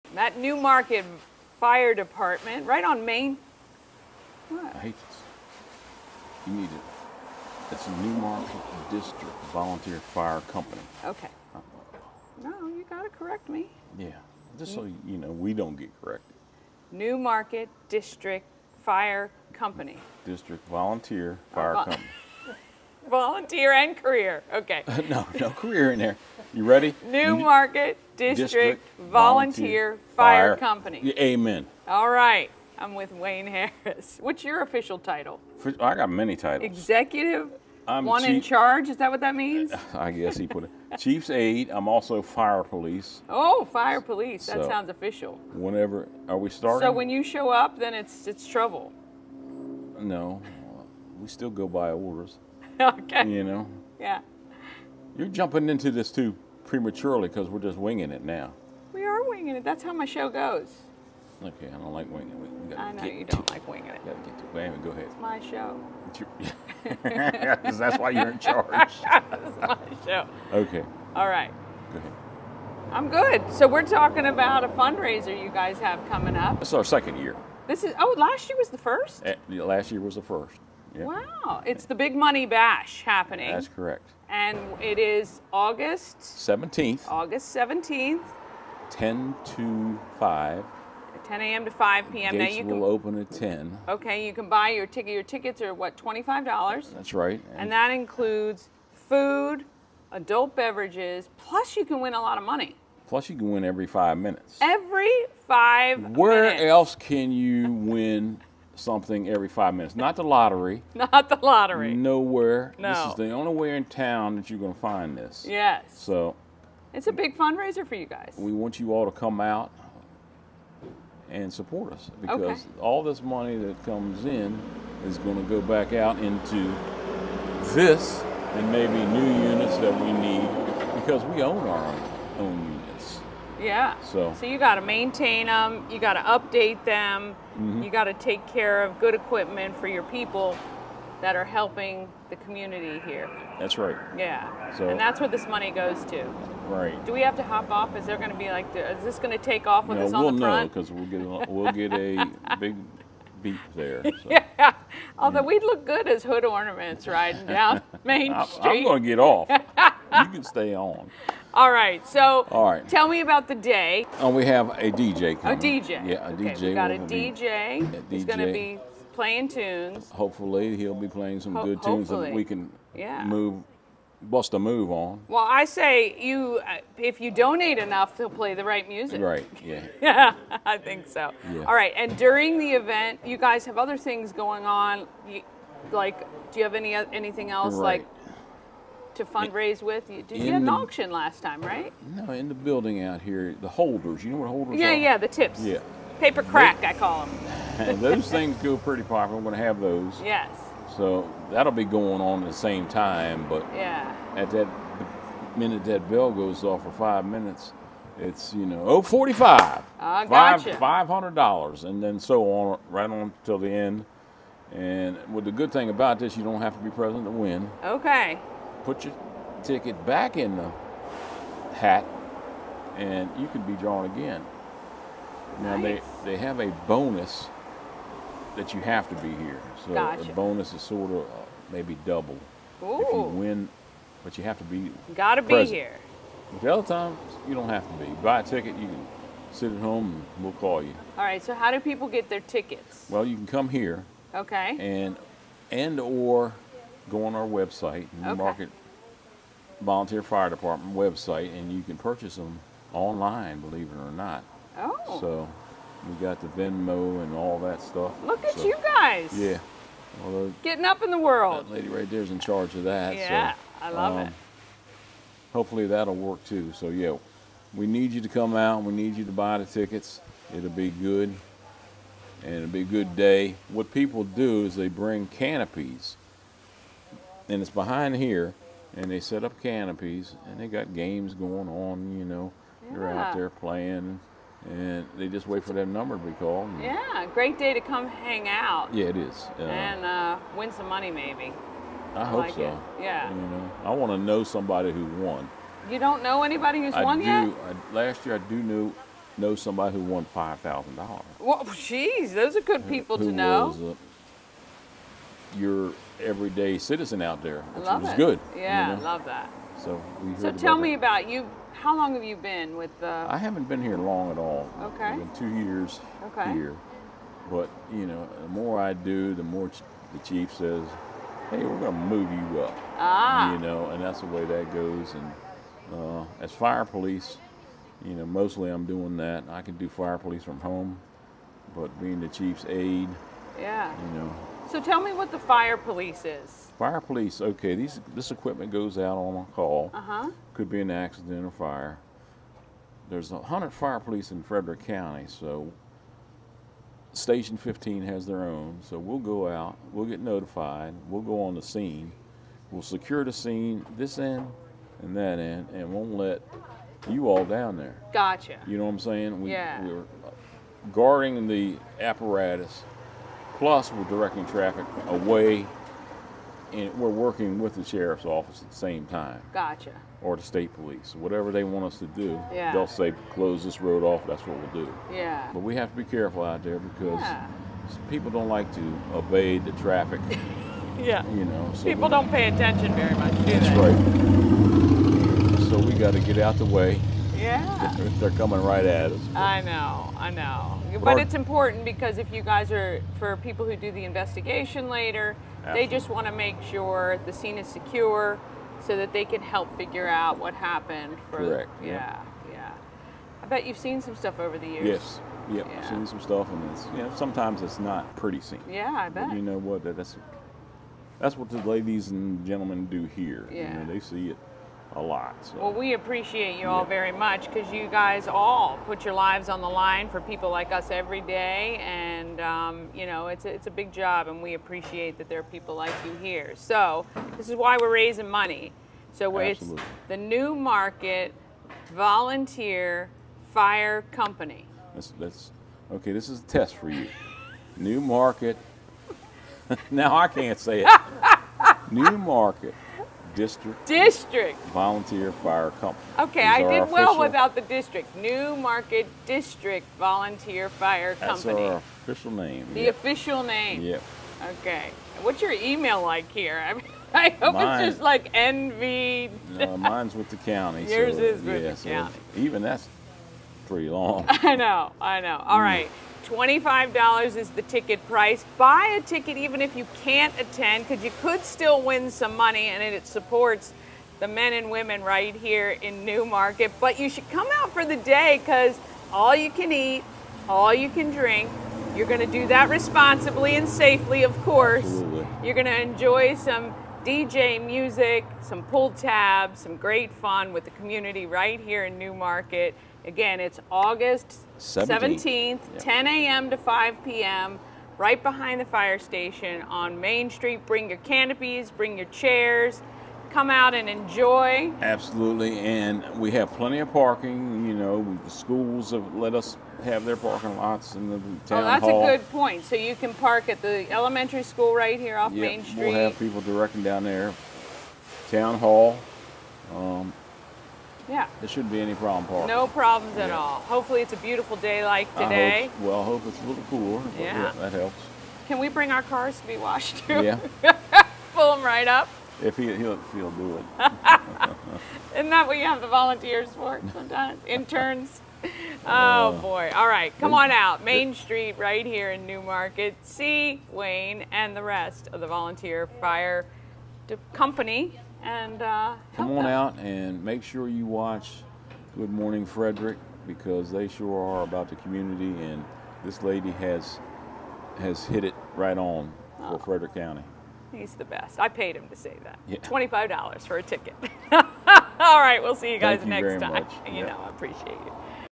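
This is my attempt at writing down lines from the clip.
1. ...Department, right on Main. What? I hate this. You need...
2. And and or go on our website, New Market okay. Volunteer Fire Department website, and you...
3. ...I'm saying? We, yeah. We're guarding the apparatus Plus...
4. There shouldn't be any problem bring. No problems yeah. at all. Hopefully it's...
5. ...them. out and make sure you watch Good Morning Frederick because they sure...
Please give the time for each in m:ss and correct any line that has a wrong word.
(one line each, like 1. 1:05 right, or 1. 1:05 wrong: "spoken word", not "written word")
1. 0:01 right
2. 4:04 right
3. 5:58 right
4. 8:41 wrong: "parking", not "bring"
5. 9:09 right.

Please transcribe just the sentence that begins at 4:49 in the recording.
Uh, and uh, win some money, maybe.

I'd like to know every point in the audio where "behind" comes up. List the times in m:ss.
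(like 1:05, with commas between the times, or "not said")
4:37, 8:18.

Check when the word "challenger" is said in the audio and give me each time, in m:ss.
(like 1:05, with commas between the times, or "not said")
not said.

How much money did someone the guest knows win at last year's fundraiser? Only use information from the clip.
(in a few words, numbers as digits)
$5,000.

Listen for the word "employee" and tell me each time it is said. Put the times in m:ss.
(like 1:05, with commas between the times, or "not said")
not said.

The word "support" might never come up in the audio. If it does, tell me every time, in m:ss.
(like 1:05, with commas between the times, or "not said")
2:01, 7:53.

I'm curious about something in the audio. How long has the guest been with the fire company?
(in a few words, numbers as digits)
Two years.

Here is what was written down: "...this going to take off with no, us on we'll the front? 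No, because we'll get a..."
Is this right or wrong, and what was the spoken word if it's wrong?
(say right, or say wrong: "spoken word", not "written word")
right.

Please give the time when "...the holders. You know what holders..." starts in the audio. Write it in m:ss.
3:13.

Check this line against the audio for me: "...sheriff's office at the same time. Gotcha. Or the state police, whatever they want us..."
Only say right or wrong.
right.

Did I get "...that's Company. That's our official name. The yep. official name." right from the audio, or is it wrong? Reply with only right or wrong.
right.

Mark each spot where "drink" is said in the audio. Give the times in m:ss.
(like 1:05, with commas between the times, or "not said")
8:01.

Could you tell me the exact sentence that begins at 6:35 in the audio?
they just want to make sure the scene is secure so that they can help figure out what happened.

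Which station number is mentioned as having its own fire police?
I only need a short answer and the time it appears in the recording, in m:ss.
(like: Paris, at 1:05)
Station 15, at 5:47.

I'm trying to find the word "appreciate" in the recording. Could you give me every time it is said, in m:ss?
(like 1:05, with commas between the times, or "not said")
6:55, 7:04, 9:27.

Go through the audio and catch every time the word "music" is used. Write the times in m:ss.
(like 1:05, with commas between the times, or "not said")
2:58, 8:07.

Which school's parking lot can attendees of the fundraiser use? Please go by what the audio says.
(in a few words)
Elementary school.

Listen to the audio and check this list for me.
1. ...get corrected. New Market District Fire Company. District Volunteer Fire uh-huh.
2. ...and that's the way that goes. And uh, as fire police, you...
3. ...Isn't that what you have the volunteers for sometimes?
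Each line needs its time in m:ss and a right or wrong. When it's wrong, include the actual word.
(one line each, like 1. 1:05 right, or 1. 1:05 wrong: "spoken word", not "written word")
1. 0:15 right
2. 5:23 right
3. 8:55 right.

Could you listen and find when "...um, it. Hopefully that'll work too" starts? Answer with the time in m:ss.
4:24.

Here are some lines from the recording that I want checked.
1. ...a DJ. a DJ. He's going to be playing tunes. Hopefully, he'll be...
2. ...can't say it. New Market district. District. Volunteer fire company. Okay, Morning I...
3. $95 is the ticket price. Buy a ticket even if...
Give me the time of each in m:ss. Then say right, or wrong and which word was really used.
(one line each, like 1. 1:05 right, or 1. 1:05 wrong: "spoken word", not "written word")
1. 2:46 right
2. 7:20 wrong: "These", not "Morning"
3. 7:46 wrong: "25", not "95".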